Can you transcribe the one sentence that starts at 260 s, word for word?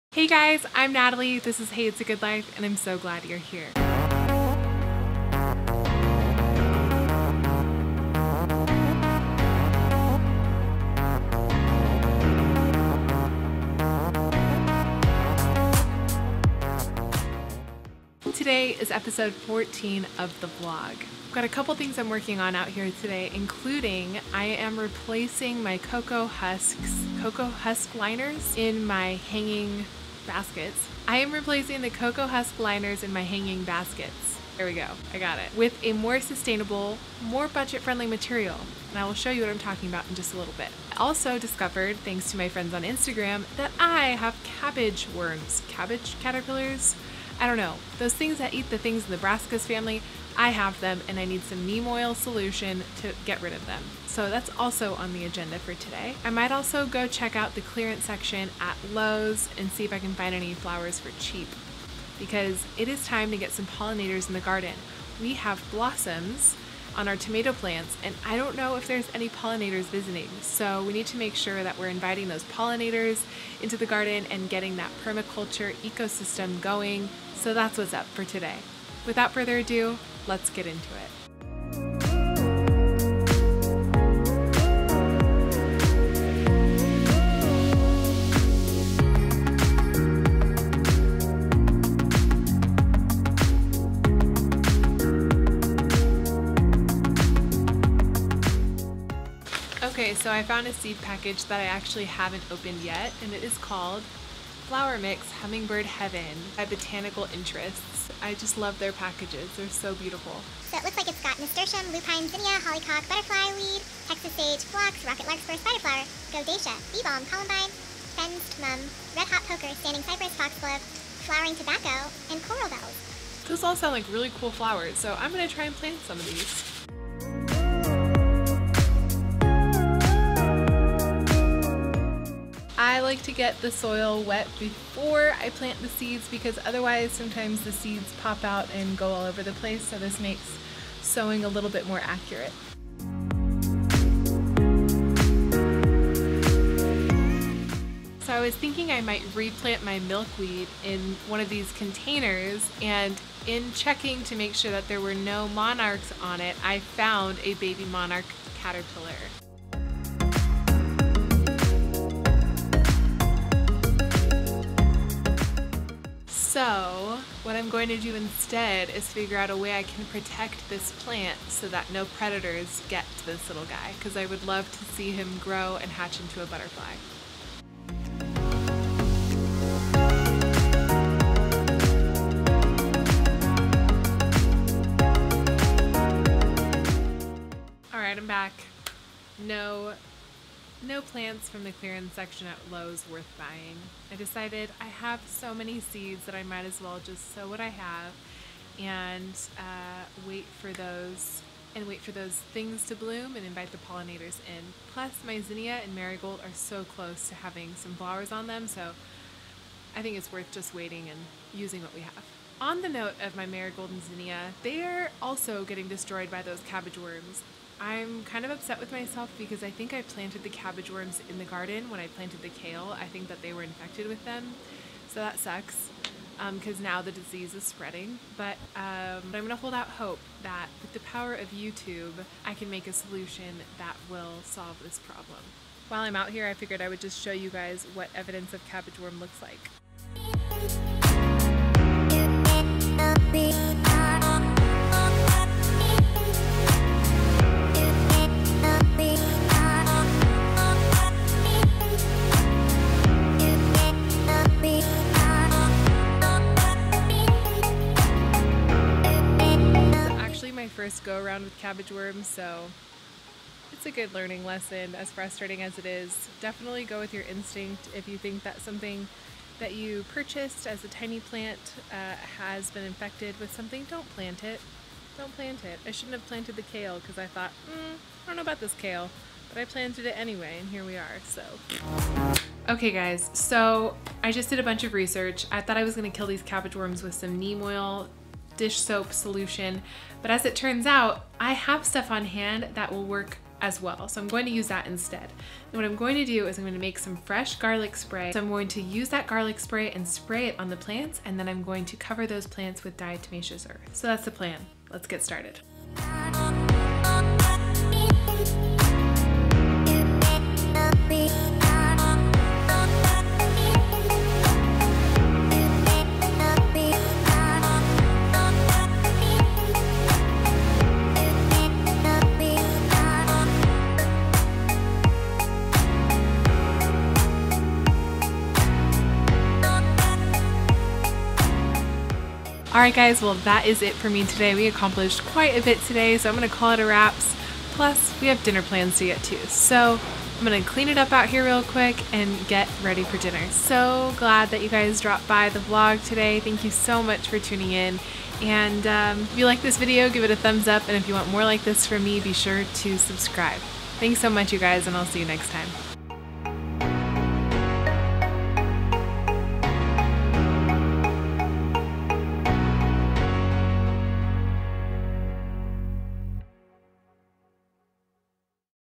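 first go around with cabbage worms, so it's a good learning lesson, as frustrating as it is.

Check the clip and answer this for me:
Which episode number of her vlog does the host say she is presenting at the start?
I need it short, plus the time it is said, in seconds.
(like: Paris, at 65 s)
14, at 18 s.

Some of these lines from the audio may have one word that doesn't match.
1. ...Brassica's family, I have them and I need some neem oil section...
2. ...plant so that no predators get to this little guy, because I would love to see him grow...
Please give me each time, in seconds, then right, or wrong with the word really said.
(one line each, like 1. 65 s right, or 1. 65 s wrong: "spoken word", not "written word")
1. 49 s wrong: "solution", not "section"
2. 171 s right.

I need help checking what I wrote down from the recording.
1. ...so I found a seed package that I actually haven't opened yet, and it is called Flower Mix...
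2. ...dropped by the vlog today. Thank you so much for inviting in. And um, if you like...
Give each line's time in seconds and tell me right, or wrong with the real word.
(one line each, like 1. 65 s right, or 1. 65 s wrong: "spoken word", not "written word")
1. 100 s right
2. 345 s wrong: "tuning", not "inviting".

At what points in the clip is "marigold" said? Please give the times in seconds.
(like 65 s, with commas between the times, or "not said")
205 s, 213 s.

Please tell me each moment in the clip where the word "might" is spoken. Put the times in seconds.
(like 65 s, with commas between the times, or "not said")
56 s, 149 s, 196 s.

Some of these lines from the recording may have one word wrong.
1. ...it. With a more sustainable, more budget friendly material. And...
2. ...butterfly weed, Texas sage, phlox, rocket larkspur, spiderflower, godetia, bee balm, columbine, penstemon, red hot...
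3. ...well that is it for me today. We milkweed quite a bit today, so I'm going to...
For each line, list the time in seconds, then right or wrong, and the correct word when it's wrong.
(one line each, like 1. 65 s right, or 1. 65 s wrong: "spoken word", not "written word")
1. 35 s right
2. 113 s right
3. 333 s wrong: "accomplished", not "milkweed".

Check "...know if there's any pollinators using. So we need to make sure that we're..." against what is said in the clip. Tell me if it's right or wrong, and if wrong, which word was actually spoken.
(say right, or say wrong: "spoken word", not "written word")
wrong: "visiting", not "using".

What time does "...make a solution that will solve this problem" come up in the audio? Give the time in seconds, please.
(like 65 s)
232 s.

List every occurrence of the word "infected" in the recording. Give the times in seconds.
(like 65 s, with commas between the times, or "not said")
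223 s, 272 s.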